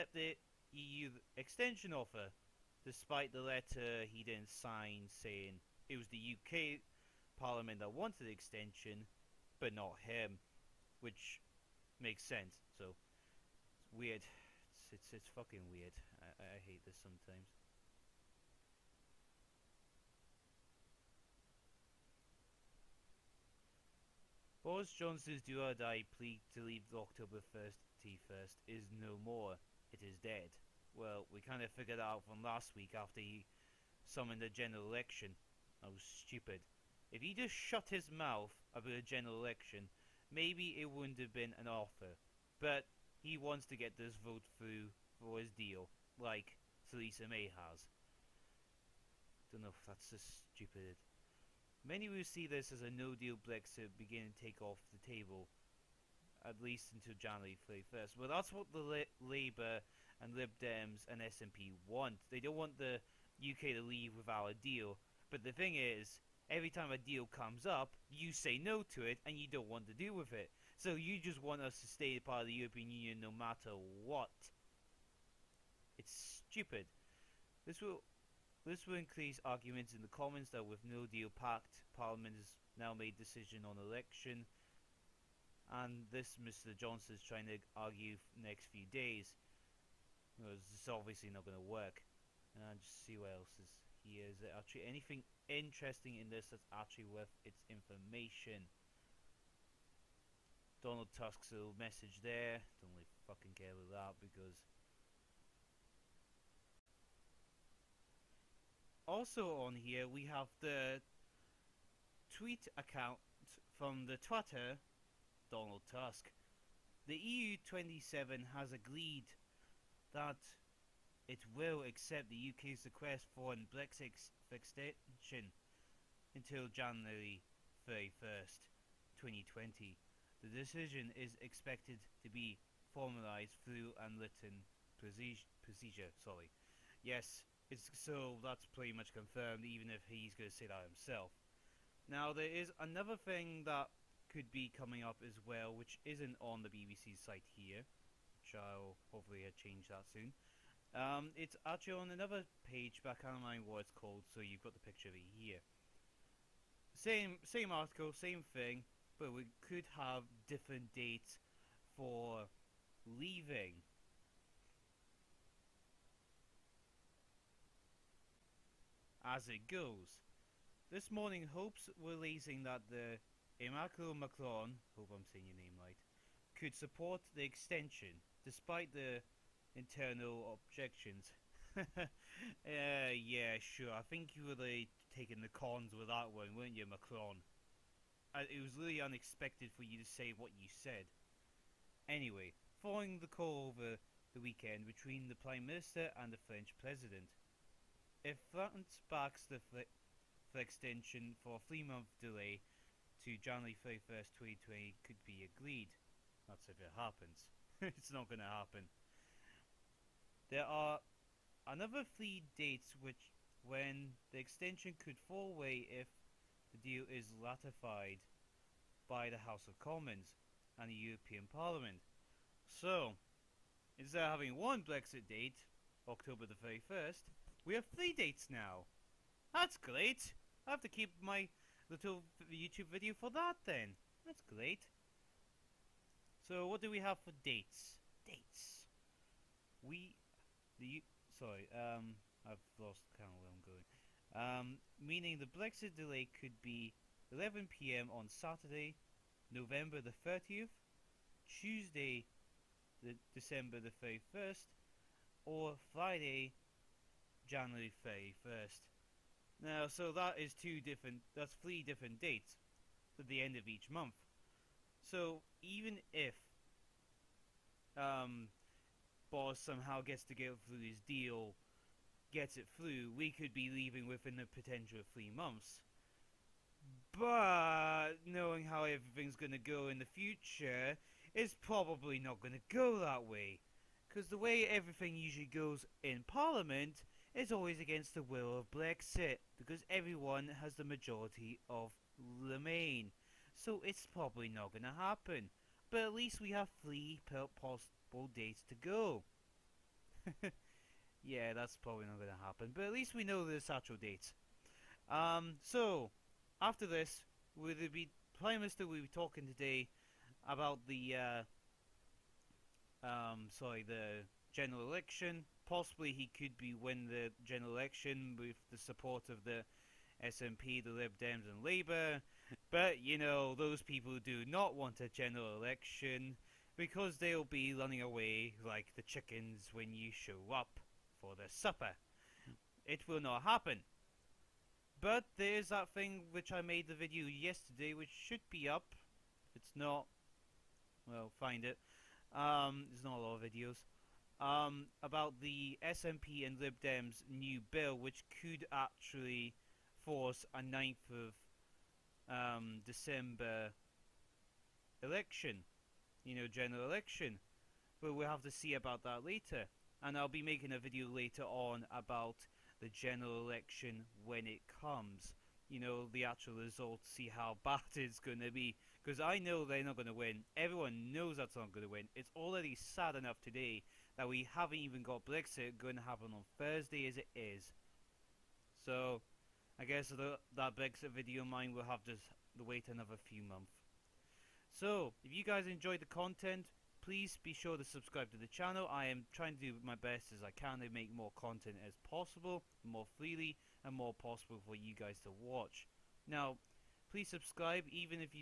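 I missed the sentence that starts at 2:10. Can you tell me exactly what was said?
The decision is expected to be formalized through an written procedure.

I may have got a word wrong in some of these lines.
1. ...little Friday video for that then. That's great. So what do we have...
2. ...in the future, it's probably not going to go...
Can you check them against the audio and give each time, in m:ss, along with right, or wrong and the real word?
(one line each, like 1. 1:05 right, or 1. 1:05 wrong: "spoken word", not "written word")
1. 3:51 wrong: "YouTube", not "Friday"
2. 4:39 right.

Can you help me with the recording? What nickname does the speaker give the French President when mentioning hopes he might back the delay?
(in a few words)
Immaculate Macron.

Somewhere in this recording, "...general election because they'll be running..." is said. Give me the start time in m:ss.
5:25.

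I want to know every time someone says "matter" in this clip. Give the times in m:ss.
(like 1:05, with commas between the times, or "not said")
1:13.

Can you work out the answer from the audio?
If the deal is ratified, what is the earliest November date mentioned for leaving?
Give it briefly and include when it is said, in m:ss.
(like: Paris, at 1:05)
November 30th, at 4:09.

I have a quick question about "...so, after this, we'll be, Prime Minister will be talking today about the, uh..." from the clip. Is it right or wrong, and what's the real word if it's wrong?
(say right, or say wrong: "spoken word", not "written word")
right.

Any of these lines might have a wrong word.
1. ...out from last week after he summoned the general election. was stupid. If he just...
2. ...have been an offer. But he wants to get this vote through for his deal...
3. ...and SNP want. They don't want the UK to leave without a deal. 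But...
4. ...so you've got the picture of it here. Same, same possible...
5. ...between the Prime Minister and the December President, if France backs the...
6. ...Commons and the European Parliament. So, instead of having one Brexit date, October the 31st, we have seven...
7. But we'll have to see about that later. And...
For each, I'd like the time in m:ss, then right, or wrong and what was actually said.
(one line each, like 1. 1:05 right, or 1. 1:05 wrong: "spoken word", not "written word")
1. 0:31 right
2. 0:41 right
3. 1:01 right
4. 2:34 wrong: "article", not "possible"
5. 3:14 wrong: "French", not "December"
6. 3:39 wrong: "three", not "seven"
7. 5:58 right.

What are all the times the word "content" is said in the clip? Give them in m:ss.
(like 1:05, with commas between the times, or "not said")
6:26, 6:31.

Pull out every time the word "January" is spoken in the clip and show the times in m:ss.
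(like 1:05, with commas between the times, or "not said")
0:57, 2:06, 3:23, 4:17.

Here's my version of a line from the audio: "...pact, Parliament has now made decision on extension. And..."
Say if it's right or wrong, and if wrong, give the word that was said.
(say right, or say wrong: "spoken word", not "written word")
wrong: "election", not "extension".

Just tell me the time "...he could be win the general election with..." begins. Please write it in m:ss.
5:16.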